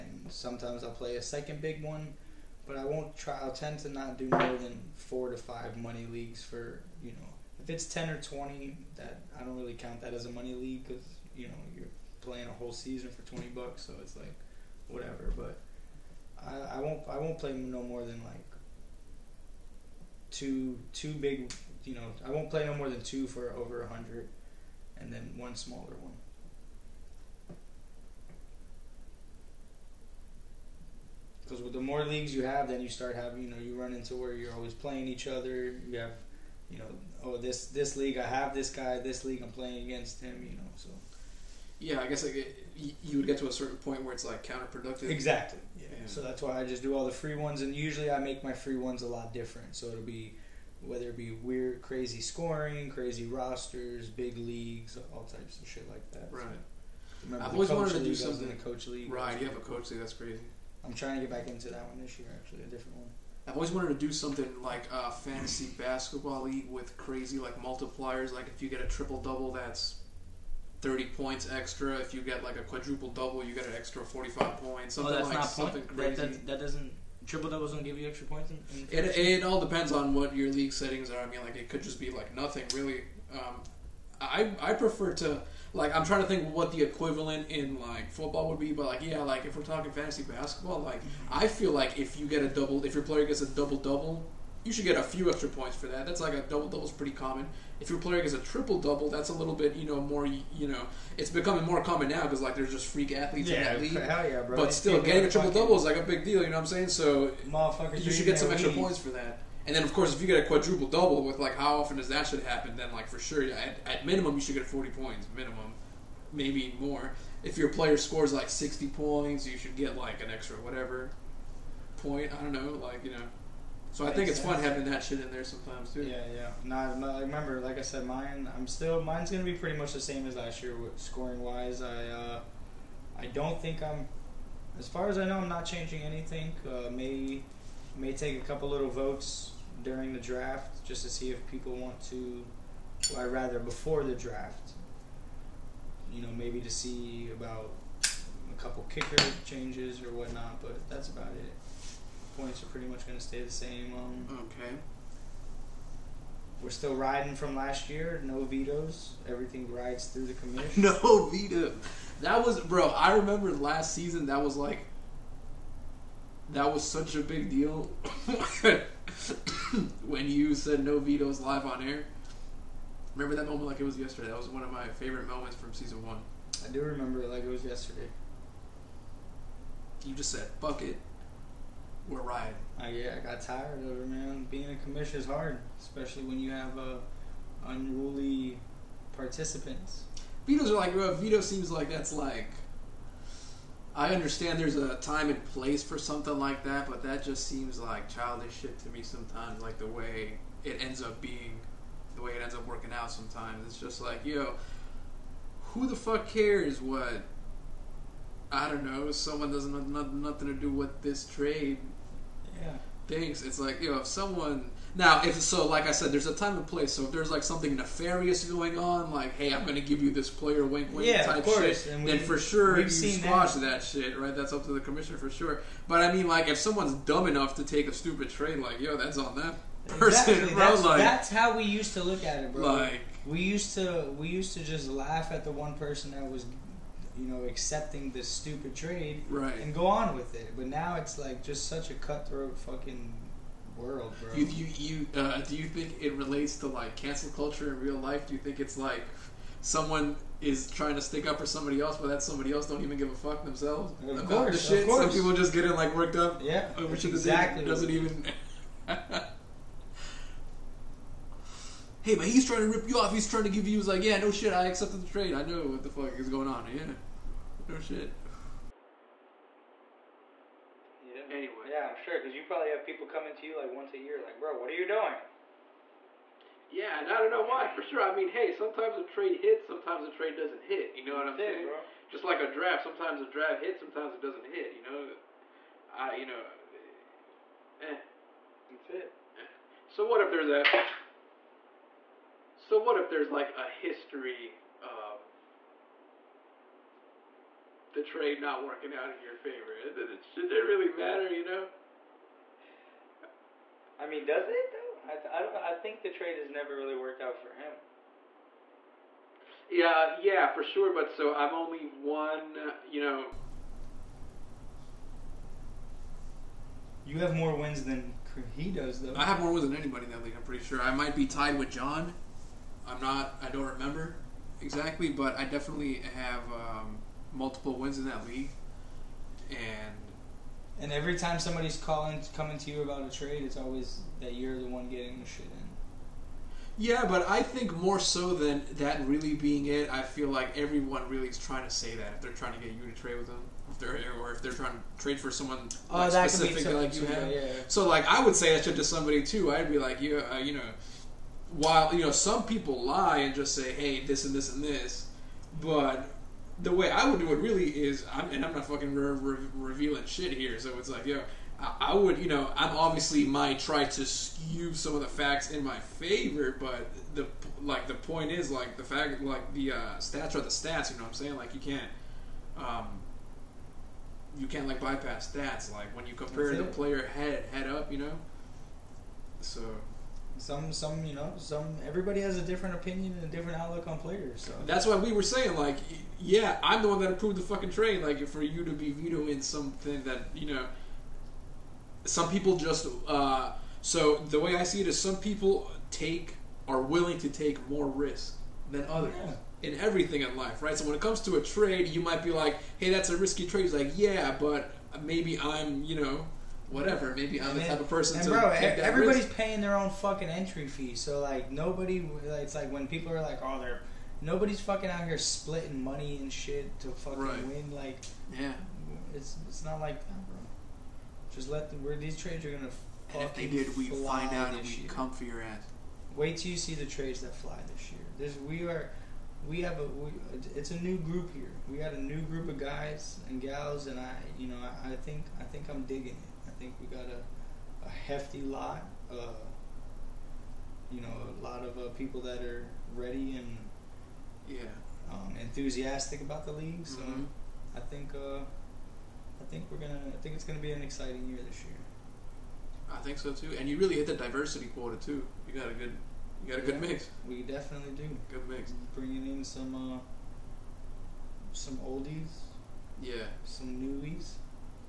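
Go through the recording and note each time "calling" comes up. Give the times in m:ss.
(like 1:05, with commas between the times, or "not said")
5:31.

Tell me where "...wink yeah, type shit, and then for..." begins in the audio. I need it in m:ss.
3:40.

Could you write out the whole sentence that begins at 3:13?
I understand there's a time and place for something like that, but that just seems like childish shit to me sometimes.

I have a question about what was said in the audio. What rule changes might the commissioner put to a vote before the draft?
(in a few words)
Kicker changes.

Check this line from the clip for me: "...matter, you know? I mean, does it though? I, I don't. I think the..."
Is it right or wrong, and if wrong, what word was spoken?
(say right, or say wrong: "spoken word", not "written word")
right.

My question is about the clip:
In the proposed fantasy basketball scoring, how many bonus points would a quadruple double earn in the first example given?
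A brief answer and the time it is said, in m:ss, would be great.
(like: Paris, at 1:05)
45, at 1:13.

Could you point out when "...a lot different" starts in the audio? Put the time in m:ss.
0:49.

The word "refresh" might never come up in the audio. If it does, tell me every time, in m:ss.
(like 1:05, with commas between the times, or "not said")
not said.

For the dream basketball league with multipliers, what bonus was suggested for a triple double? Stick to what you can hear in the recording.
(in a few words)
30 points.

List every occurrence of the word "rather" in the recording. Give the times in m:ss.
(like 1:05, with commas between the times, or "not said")
2:23.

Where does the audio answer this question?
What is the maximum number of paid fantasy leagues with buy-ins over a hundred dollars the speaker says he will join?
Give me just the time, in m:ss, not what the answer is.
0:22.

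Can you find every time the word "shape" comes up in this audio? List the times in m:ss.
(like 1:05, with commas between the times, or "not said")
not said.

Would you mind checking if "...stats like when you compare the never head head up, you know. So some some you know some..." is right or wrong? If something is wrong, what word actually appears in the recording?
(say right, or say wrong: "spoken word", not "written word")
wrong: "player", not "never".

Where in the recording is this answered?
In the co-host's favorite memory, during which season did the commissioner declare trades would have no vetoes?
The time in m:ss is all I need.
2:55.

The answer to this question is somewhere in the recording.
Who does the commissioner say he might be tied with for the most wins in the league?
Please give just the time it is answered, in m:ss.
5:21.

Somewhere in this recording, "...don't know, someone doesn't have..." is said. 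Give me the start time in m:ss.
3:28.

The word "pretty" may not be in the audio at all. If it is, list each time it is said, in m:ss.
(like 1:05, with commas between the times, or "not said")
1:36, 2:09, 2:32, 5:20.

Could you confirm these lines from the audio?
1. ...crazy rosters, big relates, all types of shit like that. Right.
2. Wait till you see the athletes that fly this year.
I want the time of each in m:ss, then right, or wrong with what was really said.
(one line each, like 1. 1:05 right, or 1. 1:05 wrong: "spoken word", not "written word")
1. 0:52 wrong: "leagues", not "relates"
2. 7:06 wrong: "trades", not "athletes".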